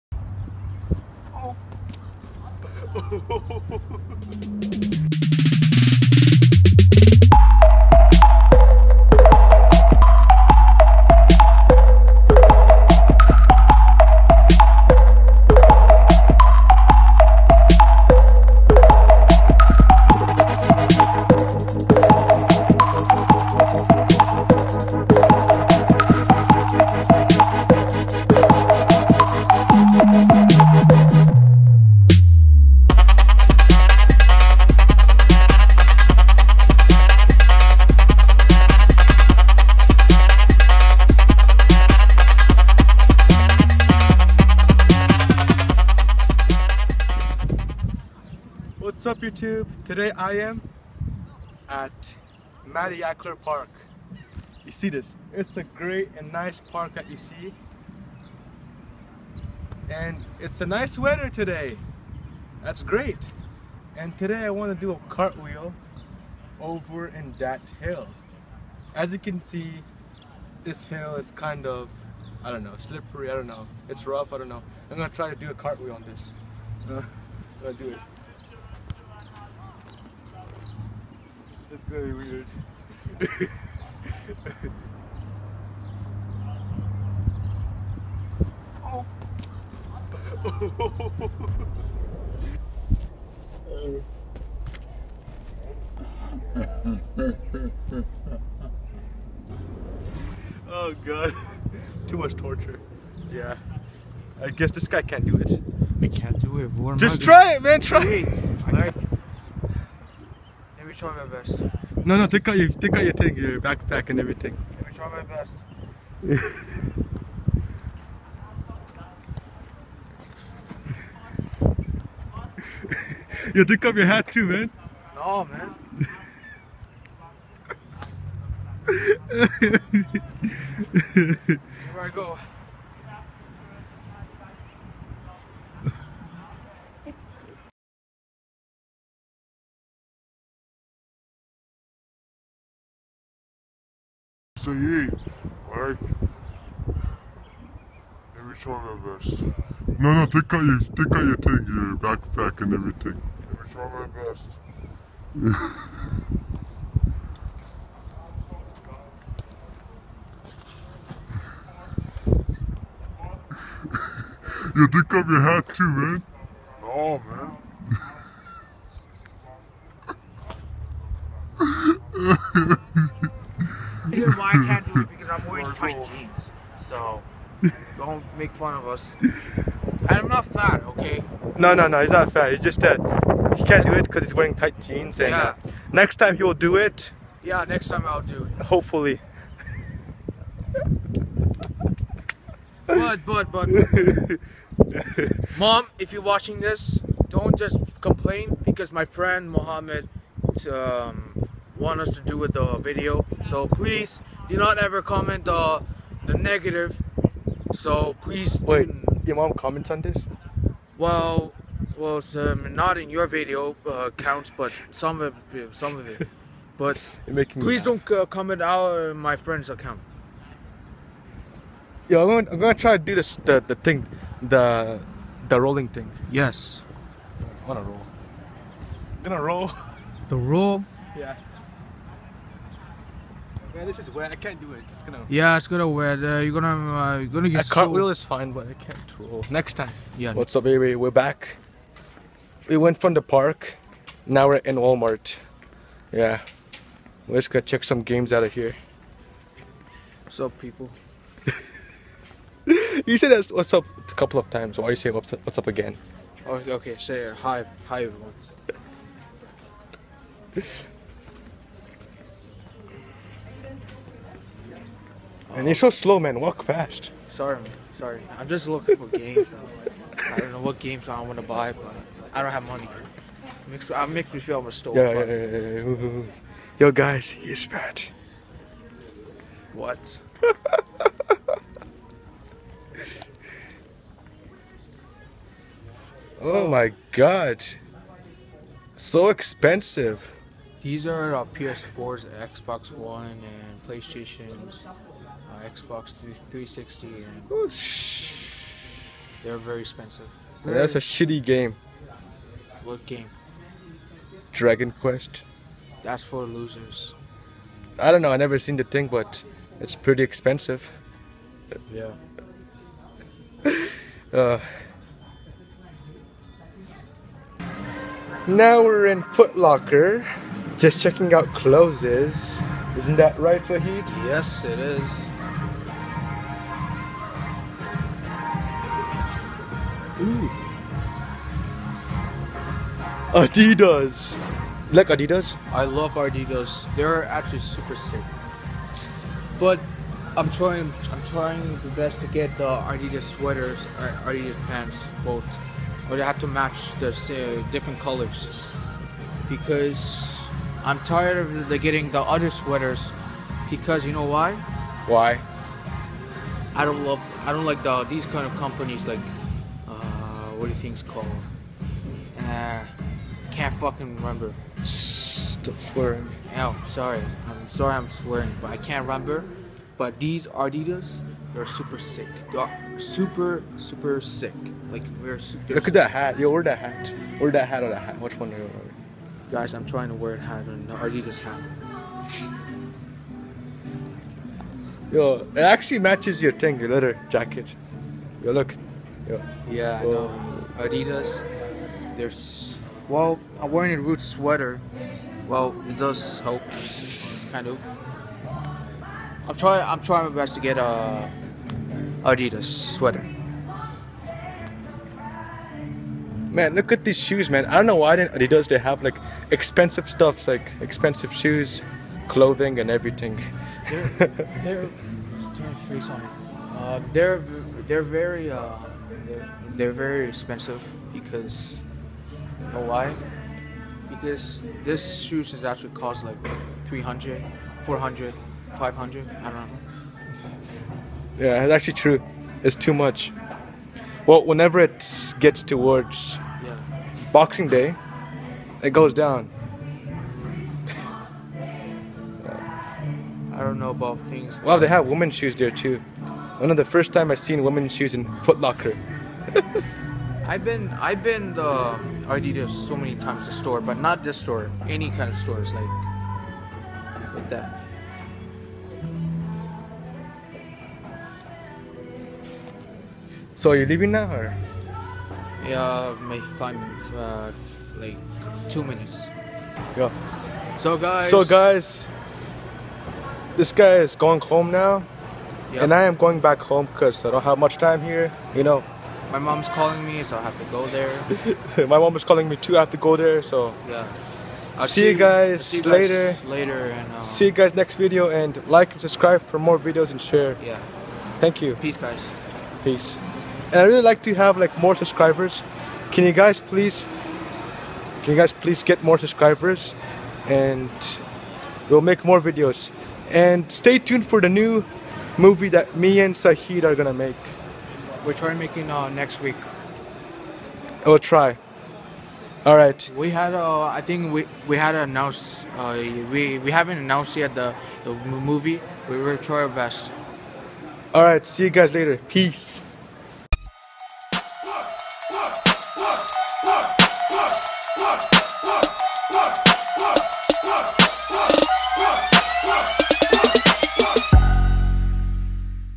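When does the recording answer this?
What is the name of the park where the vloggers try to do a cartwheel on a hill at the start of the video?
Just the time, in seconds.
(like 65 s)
52 s.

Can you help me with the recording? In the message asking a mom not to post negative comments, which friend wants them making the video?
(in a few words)
Mohammed.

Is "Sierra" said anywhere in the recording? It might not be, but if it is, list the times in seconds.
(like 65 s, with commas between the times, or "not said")
not said.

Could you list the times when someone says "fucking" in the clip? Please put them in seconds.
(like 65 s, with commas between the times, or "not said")
363 s.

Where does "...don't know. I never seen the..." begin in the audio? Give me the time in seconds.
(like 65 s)
308 s.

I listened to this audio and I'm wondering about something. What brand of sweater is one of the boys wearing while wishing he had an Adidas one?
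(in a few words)
Roots.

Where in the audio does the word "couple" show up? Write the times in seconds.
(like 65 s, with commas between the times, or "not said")
254 s.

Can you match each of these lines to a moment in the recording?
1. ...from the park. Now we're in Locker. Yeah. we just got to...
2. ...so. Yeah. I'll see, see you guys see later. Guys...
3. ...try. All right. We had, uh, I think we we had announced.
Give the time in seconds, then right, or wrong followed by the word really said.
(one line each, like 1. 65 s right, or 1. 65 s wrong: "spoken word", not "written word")
1. 242 s wrong: "Walmart", not "Locker"
2. 483 s right
3. 511 s right.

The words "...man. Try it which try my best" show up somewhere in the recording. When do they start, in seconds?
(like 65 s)
107 s.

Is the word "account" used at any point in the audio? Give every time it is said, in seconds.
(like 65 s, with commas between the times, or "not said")
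219 s.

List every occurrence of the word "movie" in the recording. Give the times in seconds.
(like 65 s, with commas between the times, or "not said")
505 s, 518 s.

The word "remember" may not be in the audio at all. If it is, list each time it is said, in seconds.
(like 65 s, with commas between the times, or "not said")
364 s, 369 s.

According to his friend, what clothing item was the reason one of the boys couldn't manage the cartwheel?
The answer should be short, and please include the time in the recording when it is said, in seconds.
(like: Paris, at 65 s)
Tight jeans, at 184 s.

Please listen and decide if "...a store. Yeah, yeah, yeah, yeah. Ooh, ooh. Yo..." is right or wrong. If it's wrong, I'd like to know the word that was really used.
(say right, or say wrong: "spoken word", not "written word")
right.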